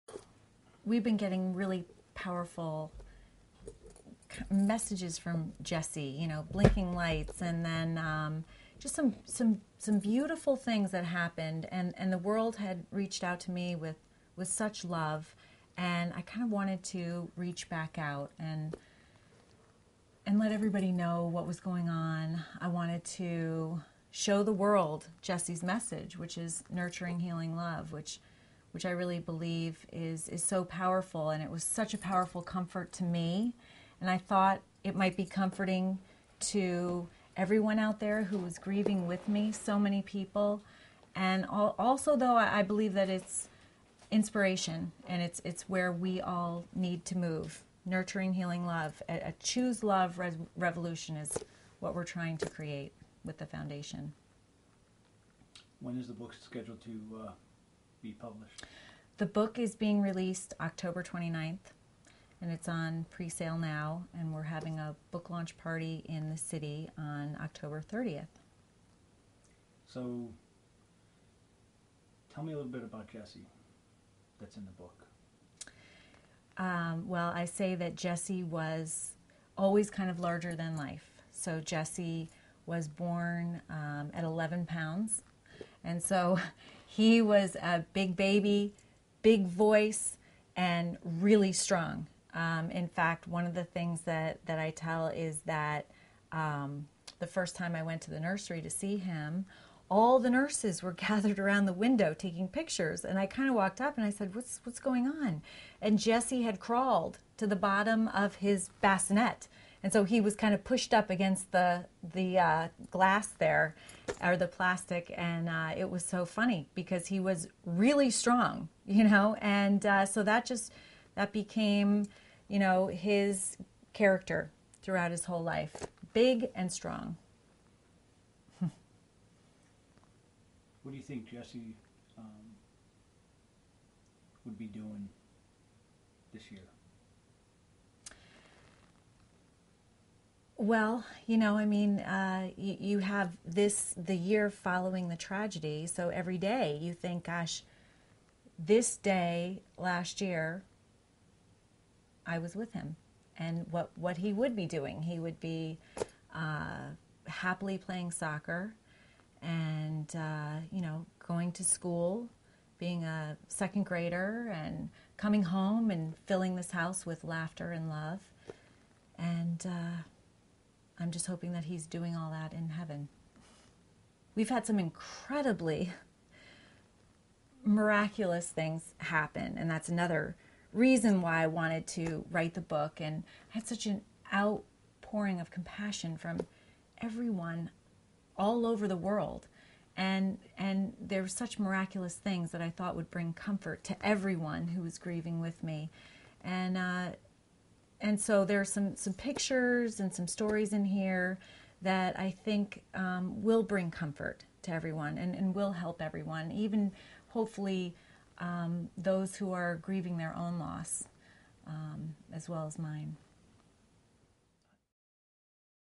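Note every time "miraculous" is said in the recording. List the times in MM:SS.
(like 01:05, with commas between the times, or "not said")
02:57, 03:11.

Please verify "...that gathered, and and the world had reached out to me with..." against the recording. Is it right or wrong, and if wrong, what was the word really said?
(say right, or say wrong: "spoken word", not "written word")
wrong: "happened", not "gathered".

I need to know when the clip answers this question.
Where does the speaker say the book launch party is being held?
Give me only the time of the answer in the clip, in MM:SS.
01:06.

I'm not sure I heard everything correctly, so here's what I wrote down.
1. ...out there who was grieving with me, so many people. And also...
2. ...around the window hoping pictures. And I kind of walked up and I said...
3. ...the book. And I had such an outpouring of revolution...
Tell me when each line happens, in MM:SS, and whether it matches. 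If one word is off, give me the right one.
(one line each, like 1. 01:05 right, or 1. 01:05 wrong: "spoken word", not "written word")
1. 00:37 right
2. 01:41 wrong: "taking", not "hoping"
3. 03:02 wrong: "compassion", not "revolution".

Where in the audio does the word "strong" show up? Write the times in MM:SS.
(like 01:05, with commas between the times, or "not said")
01:31, 01:58, 02:06.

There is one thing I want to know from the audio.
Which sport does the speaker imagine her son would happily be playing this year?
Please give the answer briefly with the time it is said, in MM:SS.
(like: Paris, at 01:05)
soccer, at 02:38.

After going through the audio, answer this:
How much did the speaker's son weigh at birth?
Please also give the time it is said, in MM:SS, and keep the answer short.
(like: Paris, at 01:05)
11 pounds, at 01:24.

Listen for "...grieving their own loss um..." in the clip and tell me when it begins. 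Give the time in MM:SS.
03:29.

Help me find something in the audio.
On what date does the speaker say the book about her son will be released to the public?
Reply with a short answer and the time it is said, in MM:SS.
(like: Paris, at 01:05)
October 29, at 01:00.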